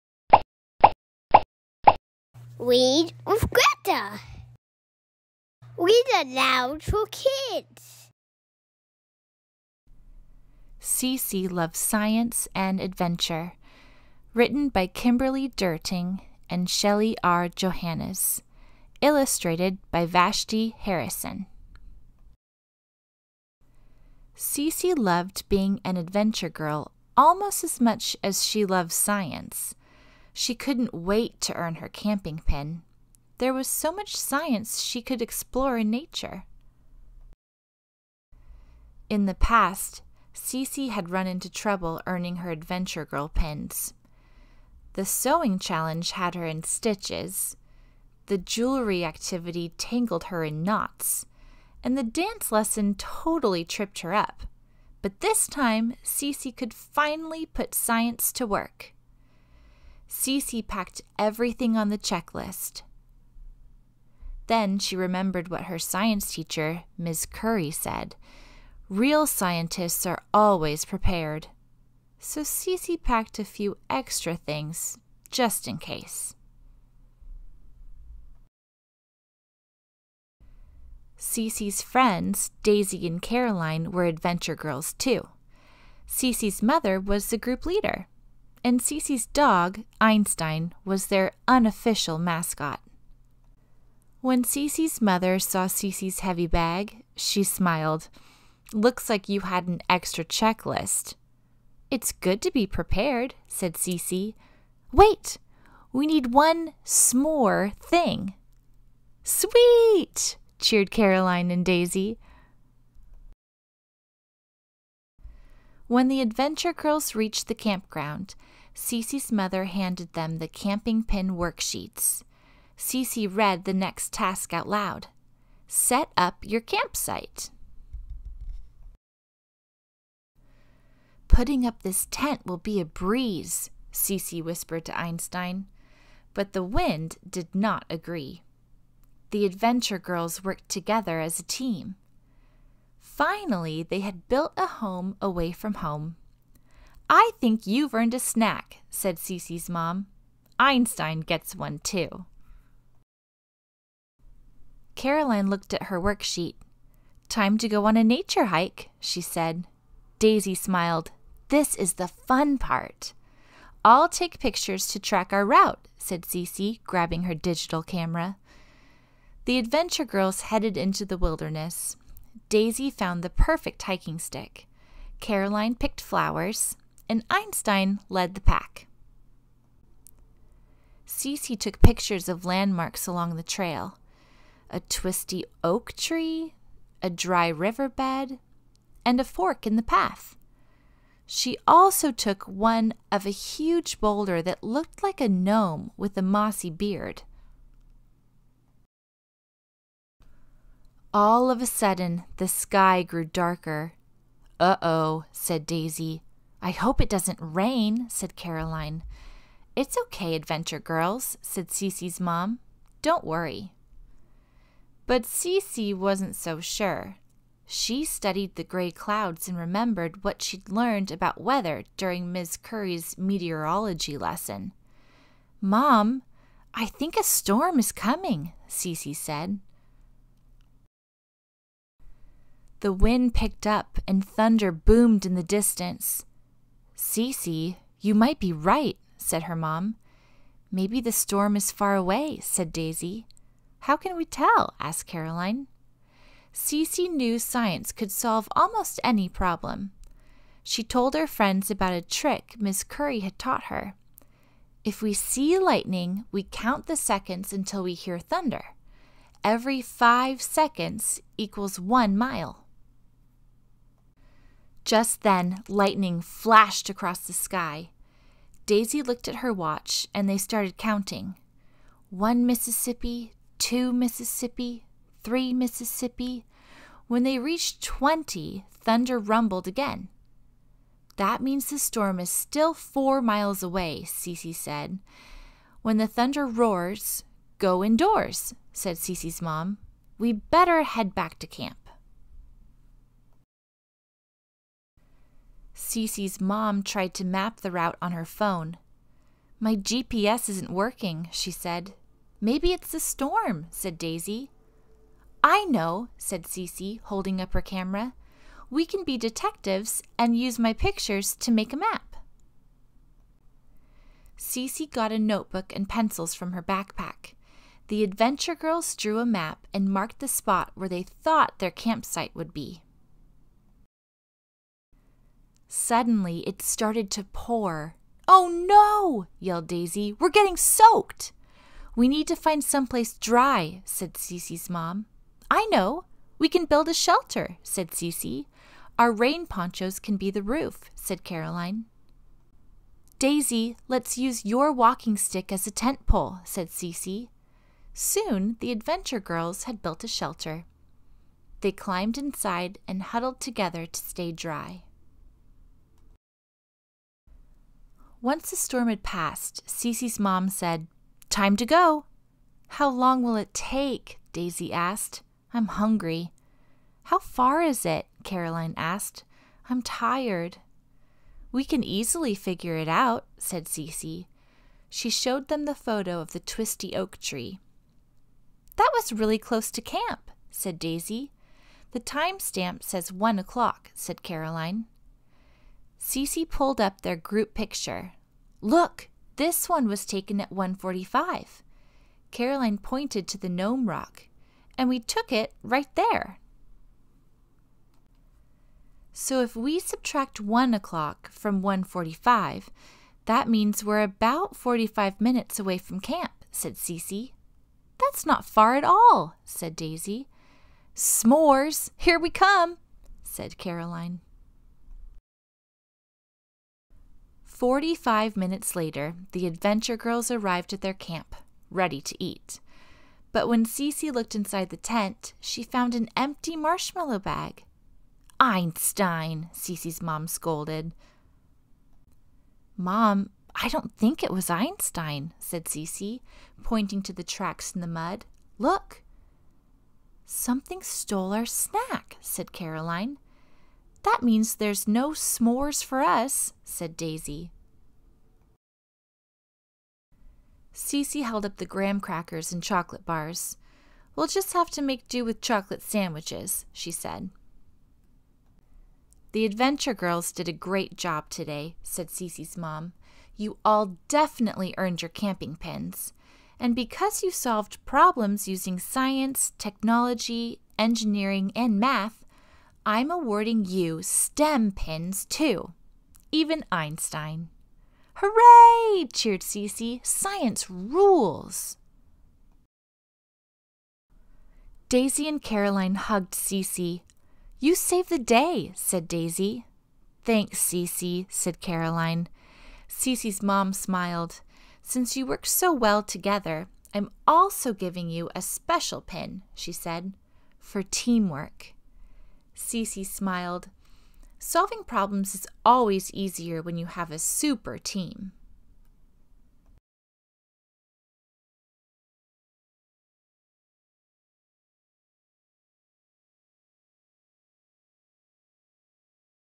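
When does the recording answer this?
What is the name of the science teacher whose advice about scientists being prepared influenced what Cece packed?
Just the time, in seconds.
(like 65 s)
66 s.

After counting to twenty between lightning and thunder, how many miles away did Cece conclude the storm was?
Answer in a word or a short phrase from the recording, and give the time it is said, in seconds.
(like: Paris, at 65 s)
4, at 282 s.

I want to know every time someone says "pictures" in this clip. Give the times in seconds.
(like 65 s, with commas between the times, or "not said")
164 s, 181 s, 310 s, 387 s.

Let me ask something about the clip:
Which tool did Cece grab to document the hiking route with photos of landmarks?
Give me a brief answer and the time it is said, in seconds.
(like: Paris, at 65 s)
digital camera, at 167 s.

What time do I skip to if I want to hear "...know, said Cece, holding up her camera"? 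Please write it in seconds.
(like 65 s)
305 s.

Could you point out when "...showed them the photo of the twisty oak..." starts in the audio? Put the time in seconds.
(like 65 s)
375 s.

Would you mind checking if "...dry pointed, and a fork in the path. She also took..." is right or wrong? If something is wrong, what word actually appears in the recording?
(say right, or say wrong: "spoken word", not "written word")
wrong: "riverbed", not "pointed".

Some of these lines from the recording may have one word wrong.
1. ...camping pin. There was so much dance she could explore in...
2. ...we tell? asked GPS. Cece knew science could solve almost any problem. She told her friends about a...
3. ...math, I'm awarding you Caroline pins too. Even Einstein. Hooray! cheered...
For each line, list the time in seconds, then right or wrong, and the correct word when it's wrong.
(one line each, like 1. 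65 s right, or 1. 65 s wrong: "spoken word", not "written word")
1. 31 s wrong: "science", not "dance"
2. 244 s wrong: "Caroline", not "GPS"
3. 471 s wrong: "STEM", not "Caroline".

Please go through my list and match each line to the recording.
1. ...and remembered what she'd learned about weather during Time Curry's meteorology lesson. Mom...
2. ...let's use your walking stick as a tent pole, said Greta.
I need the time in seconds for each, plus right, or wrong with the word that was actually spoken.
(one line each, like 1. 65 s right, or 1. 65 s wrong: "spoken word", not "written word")
1. 219 s wrong: "Miss", not "Time"
2. 343 s wrong: "Cece", not "Greta".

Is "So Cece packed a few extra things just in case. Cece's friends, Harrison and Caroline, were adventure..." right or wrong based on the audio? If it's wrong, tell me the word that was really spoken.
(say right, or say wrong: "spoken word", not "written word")
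wrong: "Daisy", not "Harrison".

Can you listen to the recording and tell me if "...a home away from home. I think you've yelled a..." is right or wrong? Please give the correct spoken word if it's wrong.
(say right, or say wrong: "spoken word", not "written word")
wrong: "earned", not "yelled".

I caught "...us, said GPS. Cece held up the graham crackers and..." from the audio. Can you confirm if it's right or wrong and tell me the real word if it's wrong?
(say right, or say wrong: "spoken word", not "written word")
wrong: "Daisy", not "GPS".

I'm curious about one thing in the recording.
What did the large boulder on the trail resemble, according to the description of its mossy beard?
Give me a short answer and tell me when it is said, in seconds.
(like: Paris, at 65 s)
a gnome, at 195 s.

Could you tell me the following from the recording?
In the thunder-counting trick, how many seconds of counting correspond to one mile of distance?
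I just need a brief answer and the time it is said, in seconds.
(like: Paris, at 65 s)
5, at 259 s.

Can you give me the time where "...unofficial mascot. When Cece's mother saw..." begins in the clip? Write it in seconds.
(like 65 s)
91 s.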